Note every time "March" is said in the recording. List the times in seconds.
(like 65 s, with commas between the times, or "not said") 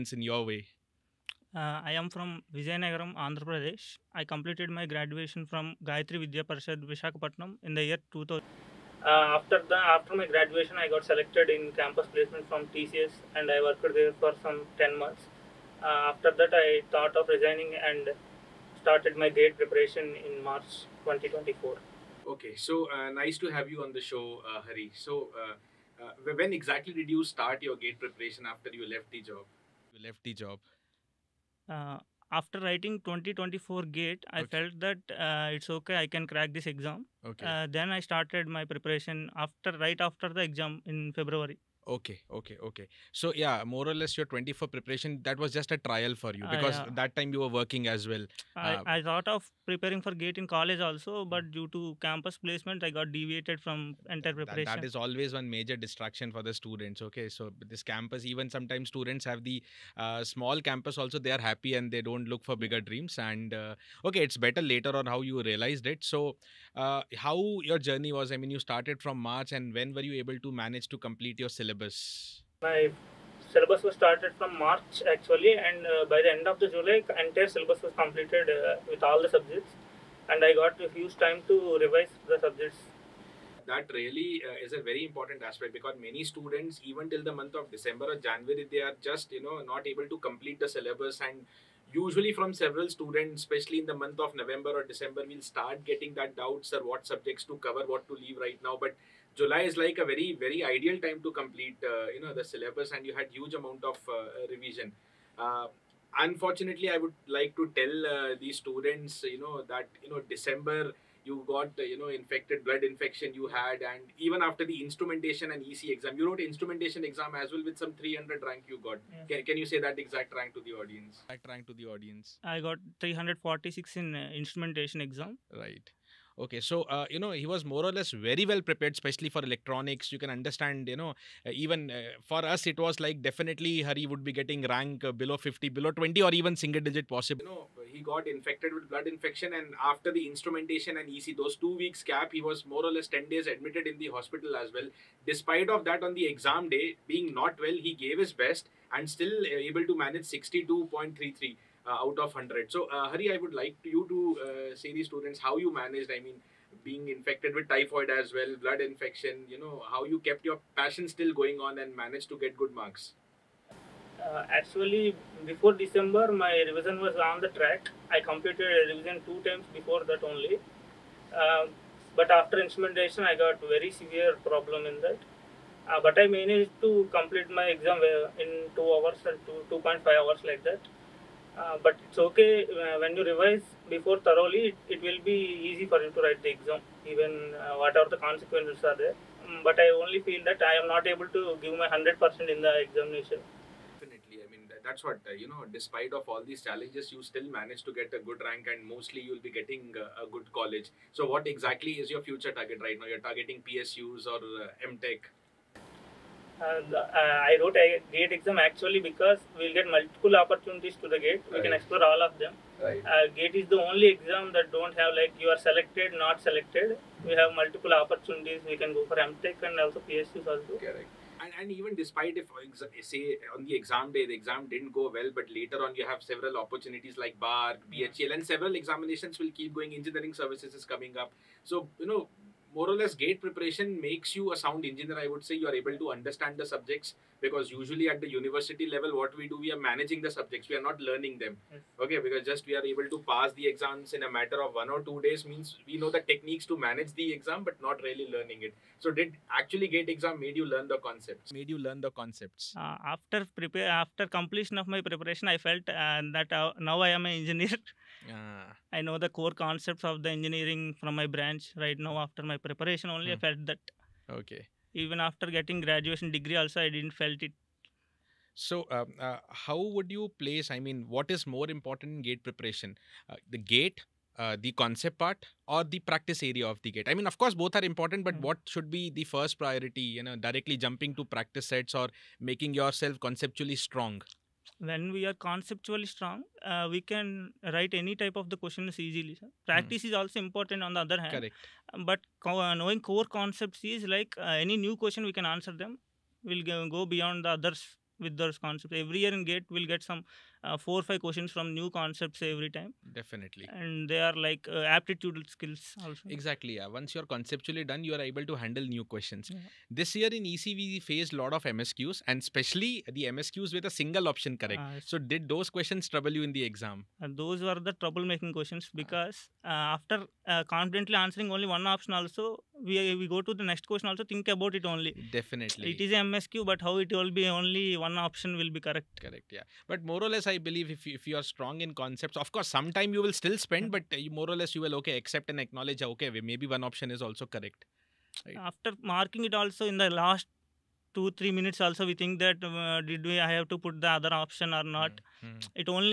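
20 s, 69 s, 74 s.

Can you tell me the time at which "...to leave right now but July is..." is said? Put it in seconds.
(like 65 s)
98 s.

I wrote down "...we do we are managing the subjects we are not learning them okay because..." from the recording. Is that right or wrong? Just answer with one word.
right.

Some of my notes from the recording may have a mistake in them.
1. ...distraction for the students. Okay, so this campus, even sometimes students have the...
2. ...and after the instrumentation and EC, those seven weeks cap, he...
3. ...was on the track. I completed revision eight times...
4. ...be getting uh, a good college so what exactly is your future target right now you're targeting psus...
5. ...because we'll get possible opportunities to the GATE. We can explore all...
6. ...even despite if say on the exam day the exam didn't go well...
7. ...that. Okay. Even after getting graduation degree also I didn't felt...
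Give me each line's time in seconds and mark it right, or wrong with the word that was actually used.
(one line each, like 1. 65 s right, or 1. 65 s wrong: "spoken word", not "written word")
1. 55 s right
2. 139 s wrong: "two", not "seven"
3. 167 s wrong: "two", not "eight"
4. 199 s right
5. 209 s wrong: "multiple", not "possible"
6. 221 s right
7. 263 s right.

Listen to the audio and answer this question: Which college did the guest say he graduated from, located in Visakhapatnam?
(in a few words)
Gayatri Vidya Parishad.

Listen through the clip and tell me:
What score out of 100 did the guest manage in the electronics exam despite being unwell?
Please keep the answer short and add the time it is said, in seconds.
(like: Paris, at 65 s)
62.33, at 150 s.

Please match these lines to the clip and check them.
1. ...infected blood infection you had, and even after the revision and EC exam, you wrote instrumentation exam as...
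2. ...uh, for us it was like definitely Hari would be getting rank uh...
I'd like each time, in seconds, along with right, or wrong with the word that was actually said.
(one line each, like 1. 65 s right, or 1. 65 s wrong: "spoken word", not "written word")
1. 112 s wrong: "instrumentation", not "revision"
2. 131 s right.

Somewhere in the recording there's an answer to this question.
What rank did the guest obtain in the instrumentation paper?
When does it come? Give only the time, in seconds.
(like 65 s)
123 s.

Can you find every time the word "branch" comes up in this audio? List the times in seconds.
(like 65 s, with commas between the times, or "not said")
261 s.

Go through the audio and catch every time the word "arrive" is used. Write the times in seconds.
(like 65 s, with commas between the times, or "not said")
not said.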